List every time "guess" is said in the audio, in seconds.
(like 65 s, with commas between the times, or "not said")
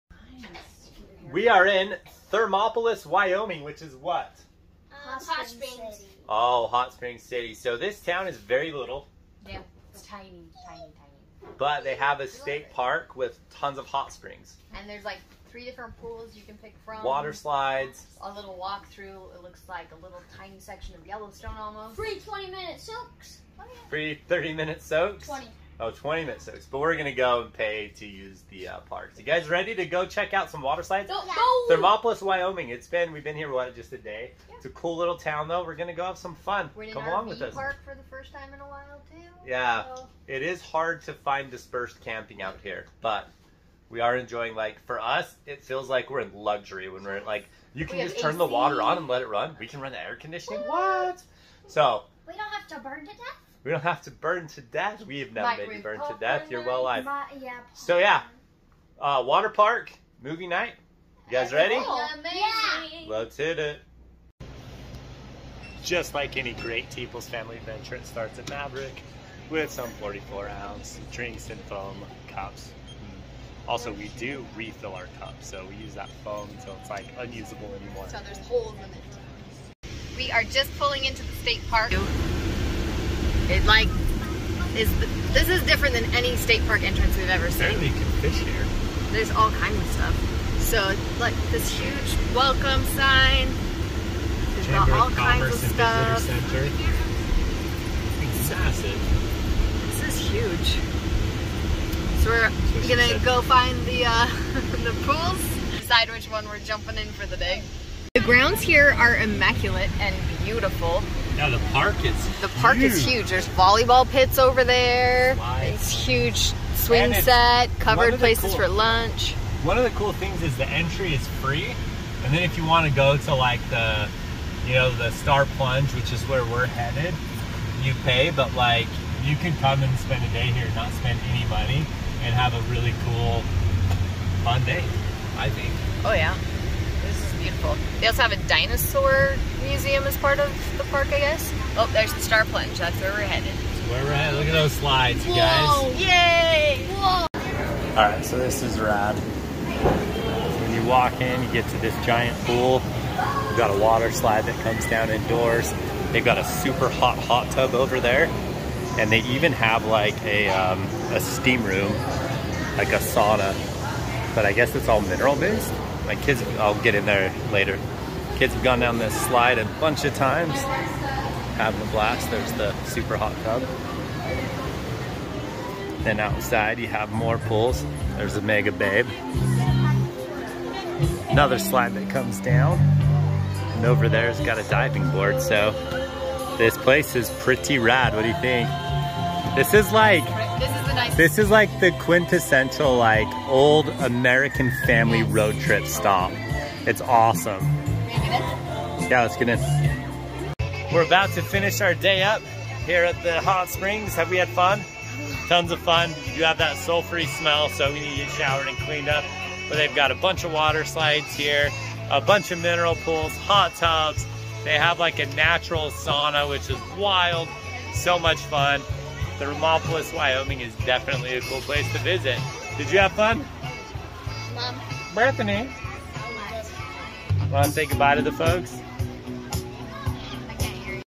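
141 s, 164 s.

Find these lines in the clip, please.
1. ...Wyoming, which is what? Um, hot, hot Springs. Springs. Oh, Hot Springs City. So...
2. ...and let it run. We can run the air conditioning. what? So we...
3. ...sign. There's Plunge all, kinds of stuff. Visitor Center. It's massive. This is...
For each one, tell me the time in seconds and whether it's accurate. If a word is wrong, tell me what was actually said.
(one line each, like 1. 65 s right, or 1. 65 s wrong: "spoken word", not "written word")
1. 3 s right
2. 48 s right
3. 92 s wrong: "Chamber", not "Plunge".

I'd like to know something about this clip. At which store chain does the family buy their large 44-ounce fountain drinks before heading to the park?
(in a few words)
Maverik.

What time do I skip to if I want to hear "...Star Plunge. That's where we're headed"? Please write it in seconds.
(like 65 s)
142 s.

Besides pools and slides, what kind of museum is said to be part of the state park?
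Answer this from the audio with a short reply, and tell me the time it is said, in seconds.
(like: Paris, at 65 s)
Dinosaur museum, at 138 s.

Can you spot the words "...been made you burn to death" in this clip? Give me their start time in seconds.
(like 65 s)
55 s.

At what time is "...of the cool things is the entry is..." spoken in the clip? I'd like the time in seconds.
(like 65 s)
119 s.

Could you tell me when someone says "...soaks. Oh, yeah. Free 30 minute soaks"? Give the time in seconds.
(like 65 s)
22 s.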